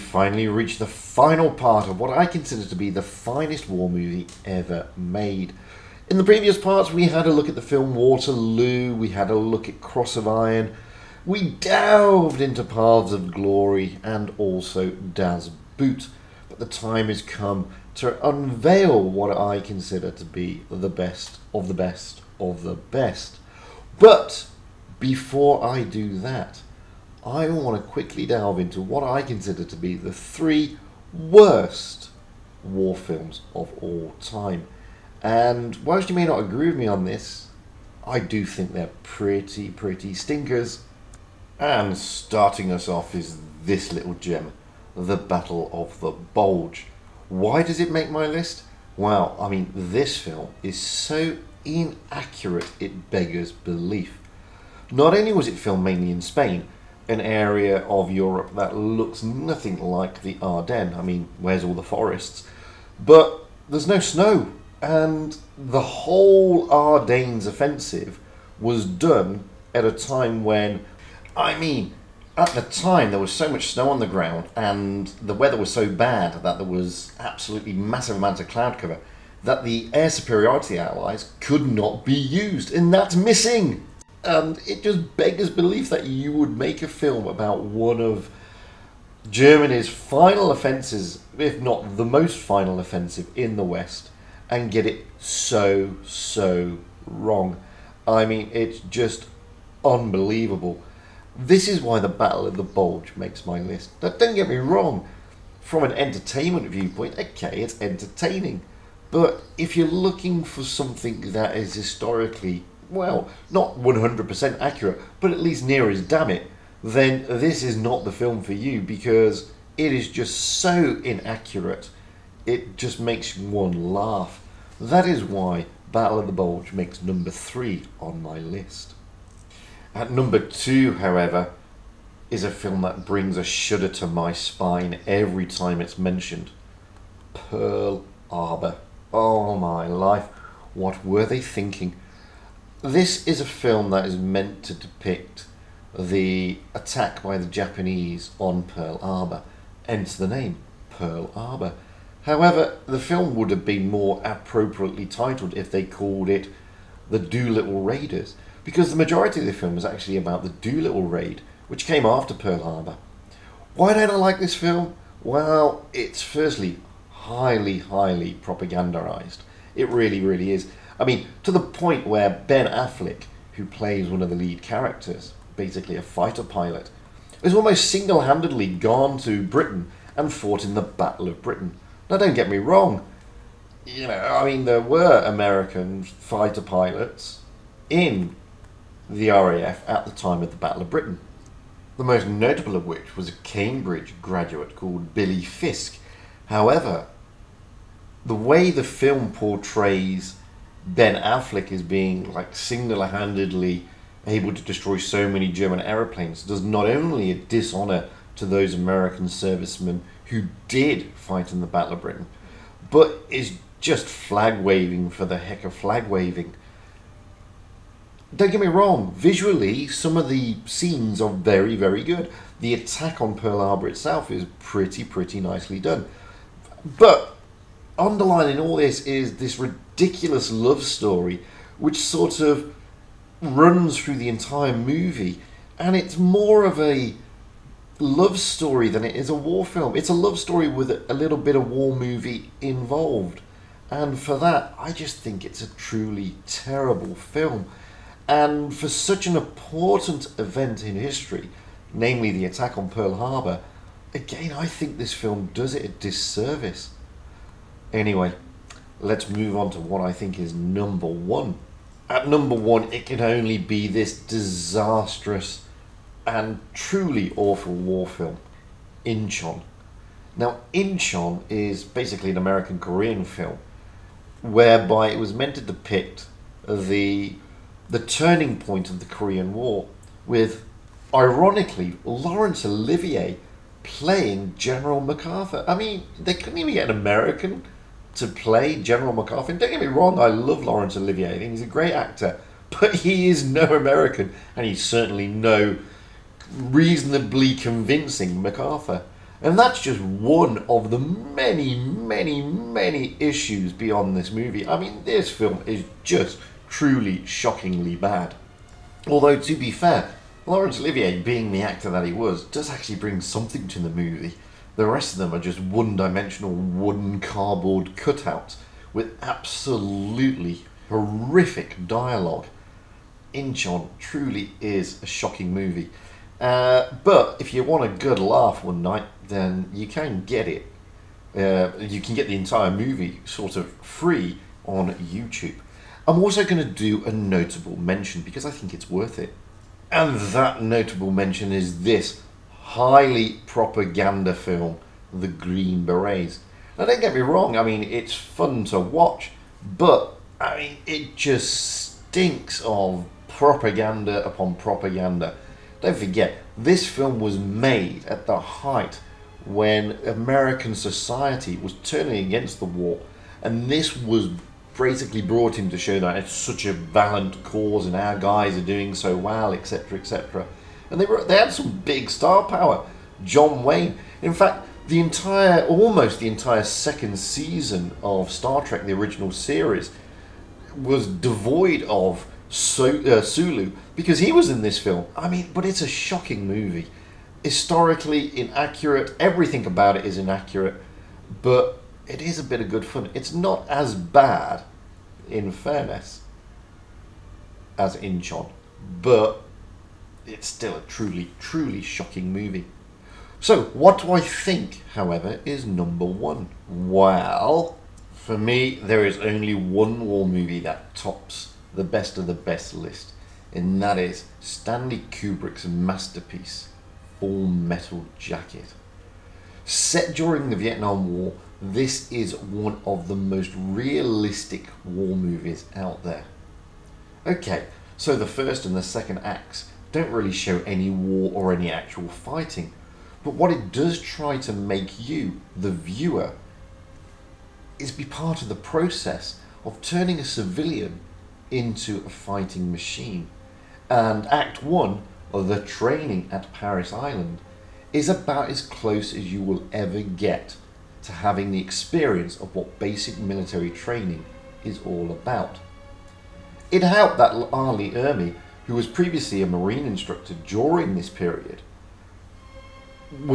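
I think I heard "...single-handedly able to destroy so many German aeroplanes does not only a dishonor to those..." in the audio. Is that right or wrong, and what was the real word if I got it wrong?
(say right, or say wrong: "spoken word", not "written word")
right.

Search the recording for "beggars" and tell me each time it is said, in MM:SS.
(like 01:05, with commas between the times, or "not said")
00:53, 01:25.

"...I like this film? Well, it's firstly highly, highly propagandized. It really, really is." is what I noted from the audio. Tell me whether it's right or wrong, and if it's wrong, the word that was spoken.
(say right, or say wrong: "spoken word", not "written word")
right.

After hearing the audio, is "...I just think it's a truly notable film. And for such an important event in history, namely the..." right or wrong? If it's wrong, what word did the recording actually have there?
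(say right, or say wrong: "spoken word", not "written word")
wrong: "terrible", not "notable".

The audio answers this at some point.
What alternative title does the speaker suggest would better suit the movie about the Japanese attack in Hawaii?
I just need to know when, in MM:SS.
02:37.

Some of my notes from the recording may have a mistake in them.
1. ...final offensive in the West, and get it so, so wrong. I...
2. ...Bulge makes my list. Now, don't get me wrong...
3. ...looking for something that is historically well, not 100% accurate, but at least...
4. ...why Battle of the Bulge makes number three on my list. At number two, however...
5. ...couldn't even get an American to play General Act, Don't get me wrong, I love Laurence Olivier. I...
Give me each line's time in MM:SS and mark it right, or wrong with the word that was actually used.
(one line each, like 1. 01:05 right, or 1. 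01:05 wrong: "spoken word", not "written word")
1. 01:32 right
2. 01:42 right
3. 01:49 right
4. 02:05 right
5. 04:46 wrong: "MacArthur", not "Act".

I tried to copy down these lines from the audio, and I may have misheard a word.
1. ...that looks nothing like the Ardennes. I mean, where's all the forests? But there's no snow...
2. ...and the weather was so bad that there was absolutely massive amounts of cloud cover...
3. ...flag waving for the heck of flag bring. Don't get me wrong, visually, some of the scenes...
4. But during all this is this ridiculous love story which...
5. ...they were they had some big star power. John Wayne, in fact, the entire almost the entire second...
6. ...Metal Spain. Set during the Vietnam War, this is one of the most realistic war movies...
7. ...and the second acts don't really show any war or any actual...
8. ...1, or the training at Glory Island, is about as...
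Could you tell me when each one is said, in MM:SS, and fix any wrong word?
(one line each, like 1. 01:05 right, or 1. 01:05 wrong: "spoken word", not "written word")
1. 00:58 right
2. 01:14 right
3. 03:34 wrong: "waving", not "bring"
4. 03:46 wrong: "underlining", not "during"
5. 06:10 right
6. 06:57 wrong: "Jacket", not "Spain"
7. 07:08 right
8. 07:24 wrong: "Parris", not "Glory".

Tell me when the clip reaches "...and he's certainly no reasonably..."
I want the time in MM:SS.
04:54.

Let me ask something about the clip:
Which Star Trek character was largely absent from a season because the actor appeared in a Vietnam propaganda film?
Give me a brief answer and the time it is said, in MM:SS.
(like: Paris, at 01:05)
Sulu, at 06:23.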